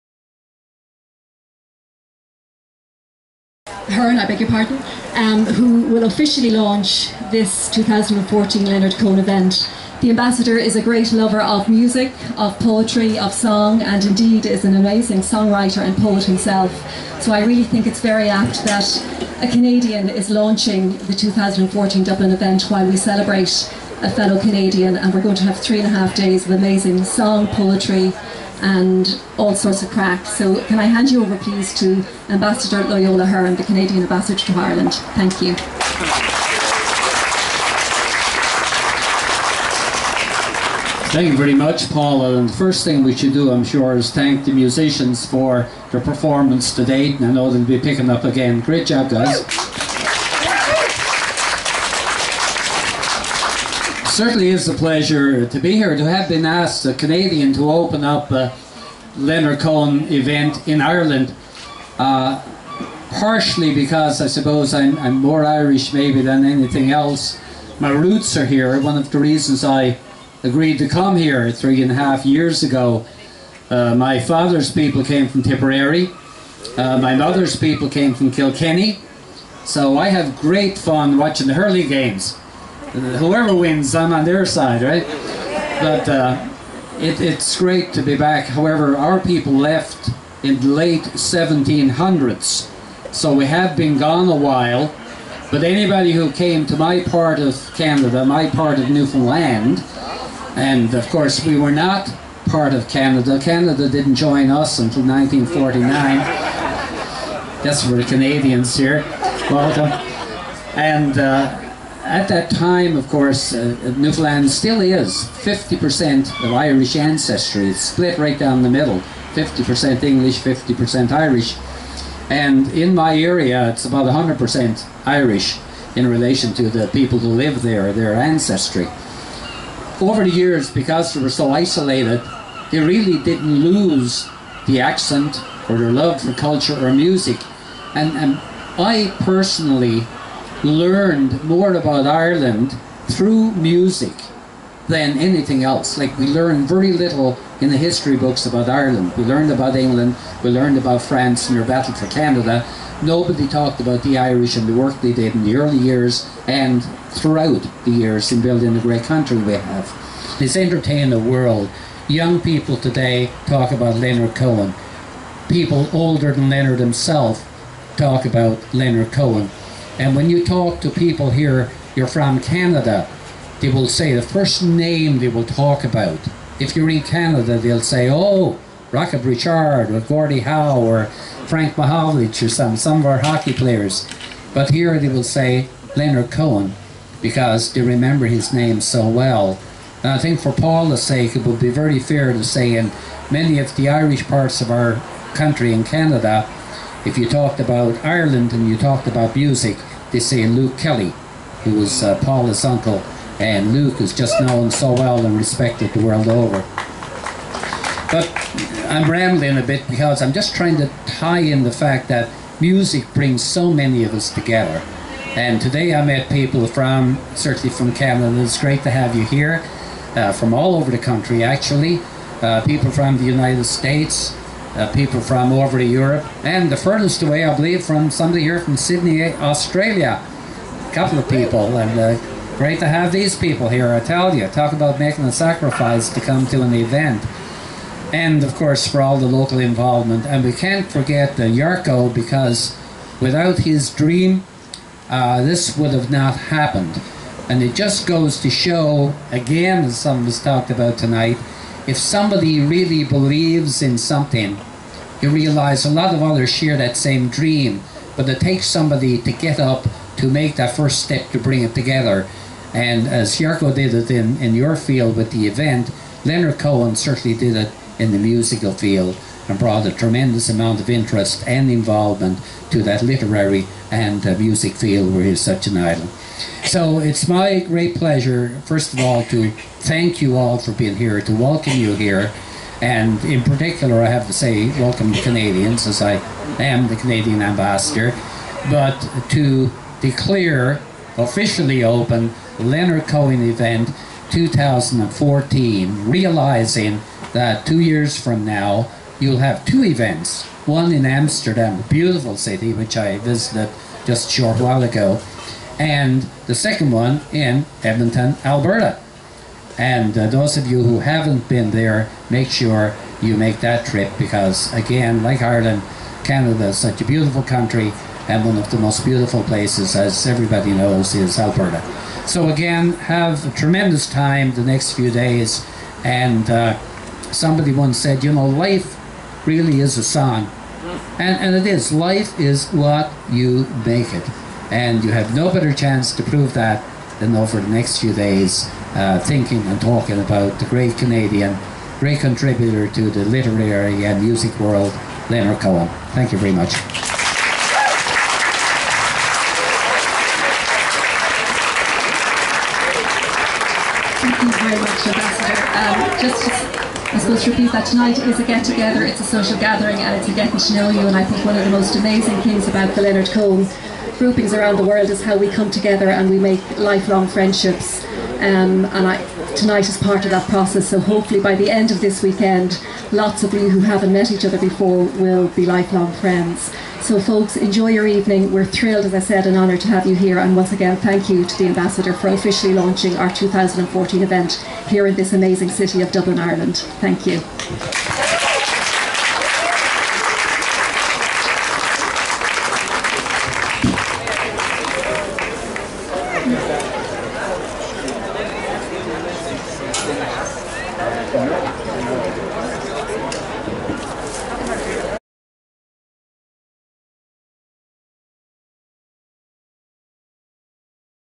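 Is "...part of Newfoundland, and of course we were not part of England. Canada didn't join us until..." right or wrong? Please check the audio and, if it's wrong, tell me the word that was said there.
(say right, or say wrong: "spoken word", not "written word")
wrong: "Canada", not "England".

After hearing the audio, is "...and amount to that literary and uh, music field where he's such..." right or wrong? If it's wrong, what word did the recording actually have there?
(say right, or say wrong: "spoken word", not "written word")
wrong: "involvement", not "amount".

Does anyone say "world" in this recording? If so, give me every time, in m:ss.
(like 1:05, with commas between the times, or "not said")
2:41, 3:26, 5:44, 6:04.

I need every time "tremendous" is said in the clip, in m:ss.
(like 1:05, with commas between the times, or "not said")
4:29, 5:23.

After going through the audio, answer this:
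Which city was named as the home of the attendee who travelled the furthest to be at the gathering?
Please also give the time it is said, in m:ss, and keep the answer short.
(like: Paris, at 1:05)
Sydney, Australia, at 3:48.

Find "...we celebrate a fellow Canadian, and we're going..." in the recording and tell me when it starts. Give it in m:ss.
0:22.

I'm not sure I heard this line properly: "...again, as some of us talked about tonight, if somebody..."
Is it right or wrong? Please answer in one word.
right.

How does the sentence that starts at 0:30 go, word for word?
So can I hand you over please to Ambassador Loyola Hearn, the Canadian Ambassador to Ireland.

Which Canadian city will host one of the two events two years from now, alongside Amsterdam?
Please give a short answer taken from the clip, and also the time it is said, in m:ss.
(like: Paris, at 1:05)
Edmonton, at 5:07.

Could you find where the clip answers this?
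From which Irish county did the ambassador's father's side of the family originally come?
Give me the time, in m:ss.
1:15.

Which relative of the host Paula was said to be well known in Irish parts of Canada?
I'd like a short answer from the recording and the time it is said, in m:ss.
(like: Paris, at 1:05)
Luke Kelly, at 3:20.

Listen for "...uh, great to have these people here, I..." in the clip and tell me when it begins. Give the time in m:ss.
3:51.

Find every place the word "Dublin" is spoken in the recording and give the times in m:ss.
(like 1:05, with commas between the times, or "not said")
0:22, 6:26.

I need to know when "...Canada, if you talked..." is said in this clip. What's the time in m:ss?
3:15.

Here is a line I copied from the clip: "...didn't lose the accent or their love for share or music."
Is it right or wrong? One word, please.
wrong.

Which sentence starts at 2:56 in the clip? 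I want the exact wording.
If you're in Canada, they'll say, oh, Rocket Richard or Gordie Howe or Frank Mahovlich or some, some of our hockey players.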